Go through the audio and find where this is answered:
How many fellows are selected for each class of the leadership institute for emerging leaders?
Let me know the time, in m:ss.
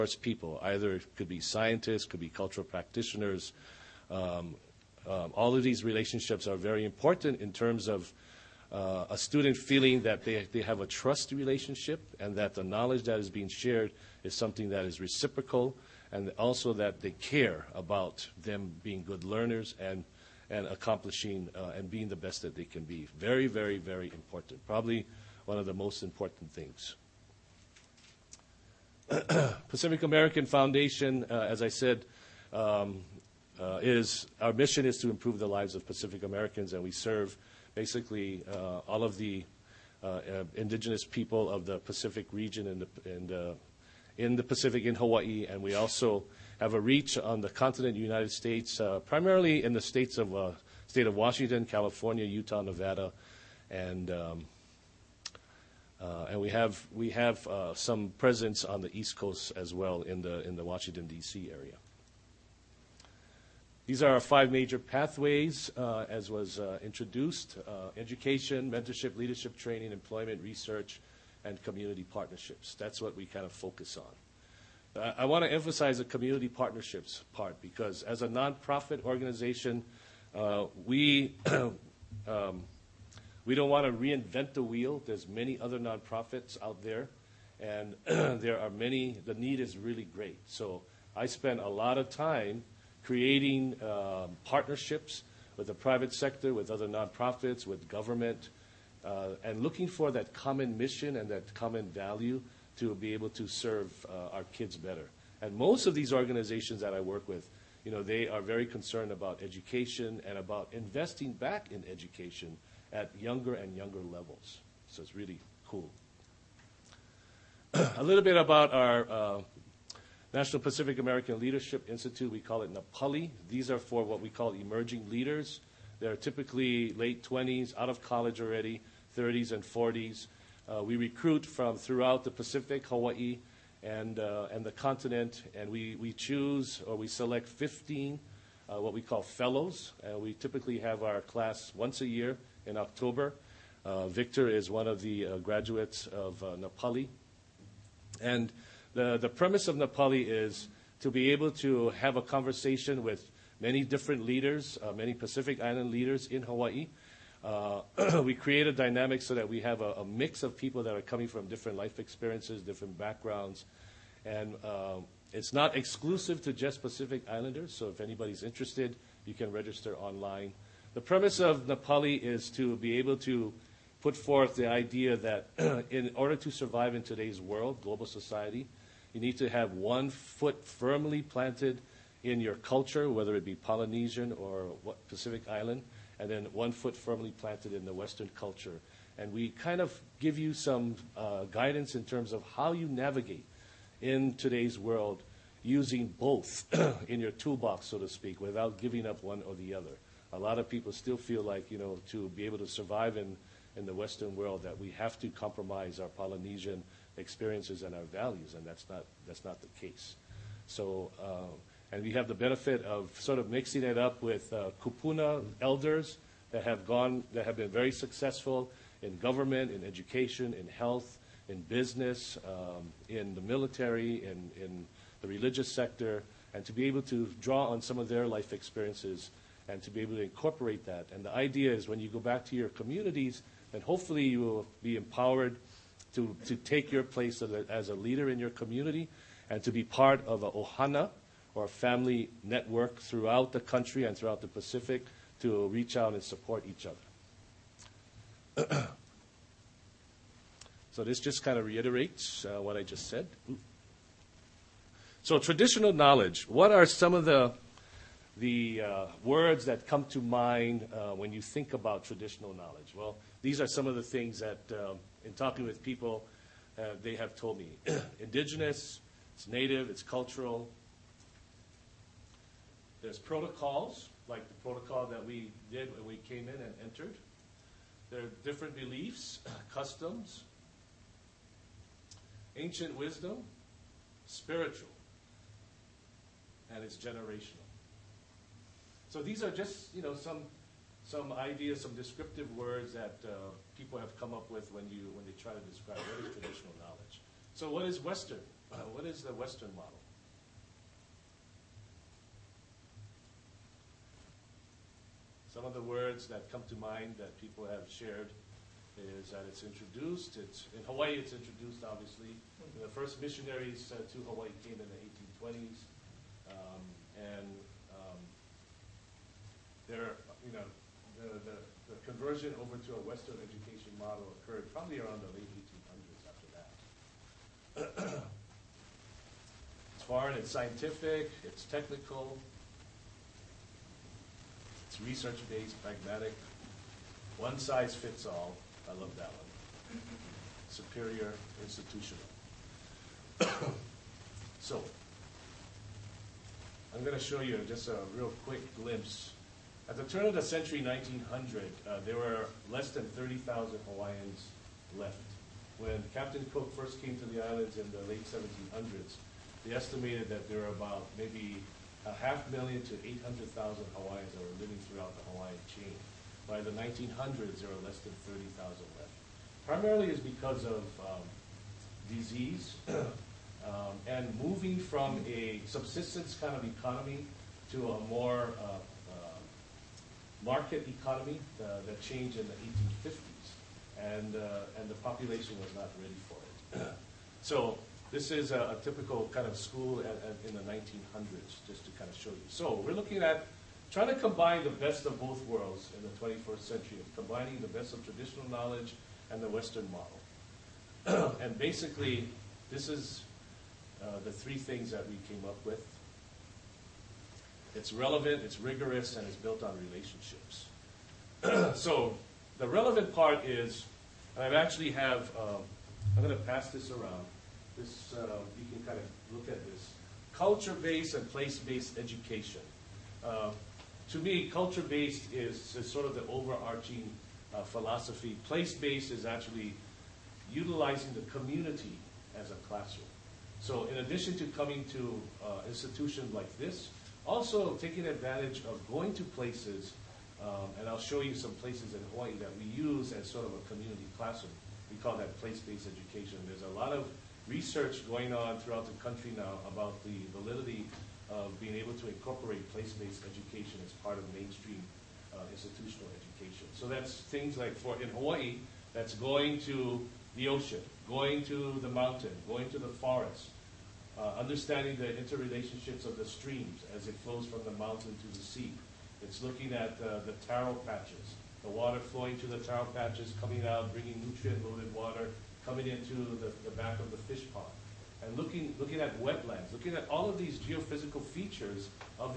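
2:17.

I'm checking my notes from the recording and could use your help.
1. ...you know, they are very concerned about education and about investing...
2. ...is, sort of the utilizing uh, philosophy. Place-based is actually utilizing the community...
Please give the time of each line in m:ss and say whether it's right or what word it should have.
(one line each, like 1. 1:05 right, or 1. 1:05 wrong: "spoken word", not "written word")
1. 1:47 right
2. 7:05 wrong: "overarching", not "utilizing".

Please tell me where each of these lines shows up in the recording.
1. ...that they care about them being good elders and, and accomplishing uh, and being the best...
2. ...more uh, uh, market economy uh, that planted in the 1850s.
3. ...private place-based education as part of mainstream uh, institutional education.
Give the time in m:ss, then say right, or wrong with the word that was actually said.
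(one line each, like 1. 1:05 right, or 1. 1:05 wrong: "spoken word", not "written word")
1. 0:16 wrong: "learners", not "elders"
2. 6:18 wrong: "changed", not "planted"
3. 7:32 wrong: "incorporate", not "private".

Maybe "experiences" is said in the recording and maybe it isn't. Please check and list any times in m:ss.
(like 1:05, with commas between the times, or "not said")
2:41, 3:27, 3:48.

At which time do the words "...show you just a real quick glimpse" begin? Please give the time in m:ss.
5:47.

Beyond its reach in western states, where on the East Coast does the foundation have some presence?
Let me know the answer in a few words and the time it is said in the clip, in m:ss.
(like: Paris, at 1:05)
Washington D.C., at 1:00.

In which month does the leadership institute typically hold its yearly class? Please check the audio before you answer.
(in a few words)
October.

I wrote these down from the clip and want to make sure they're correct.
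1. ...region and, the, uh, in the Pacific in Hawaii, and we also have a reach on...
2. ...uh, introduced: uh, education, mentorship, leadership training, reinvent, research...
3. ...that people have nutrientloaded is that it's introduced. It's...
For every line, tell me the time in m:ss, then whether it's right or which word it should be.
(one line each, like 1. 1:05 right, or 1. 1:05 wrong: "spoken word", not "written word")
1. 0:42 right
2. 1:06 wrong: "employment", not "reinvent"
3. 5:07 wrong: "shared", not "nutrientloaded".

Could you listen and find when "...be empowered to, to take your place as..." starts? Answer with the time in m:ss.
3:54.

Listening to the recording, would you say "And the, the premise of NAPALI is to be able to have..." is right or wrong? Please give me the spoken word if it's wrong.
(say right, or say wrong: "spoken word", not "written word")
right.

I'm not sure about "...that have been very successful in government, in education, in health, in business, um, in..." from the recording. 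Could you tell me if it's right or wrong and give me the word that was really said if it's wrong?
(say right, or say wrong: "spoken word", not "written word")
right.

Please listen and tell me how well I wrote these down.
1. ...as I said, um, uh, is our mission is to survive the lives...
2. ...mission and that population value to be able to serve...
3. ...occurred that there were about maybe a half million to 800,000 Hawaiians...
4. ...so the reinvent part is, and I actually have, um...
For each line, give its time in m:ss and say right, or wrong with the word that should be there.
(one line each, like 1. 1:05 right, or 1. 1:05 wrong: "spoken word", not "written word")
1. 0:31 wrong: "improve", not "survive"
2. 1:40 wrong: "common", not "population"
3. 5:59 wrong: "estimated", not "occurred"
4. 6:51 wrong: "relevant", not "reinvent".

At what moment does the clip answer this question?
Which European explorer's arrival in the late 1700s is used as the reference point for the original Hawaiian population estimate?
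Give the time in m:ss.
5:56.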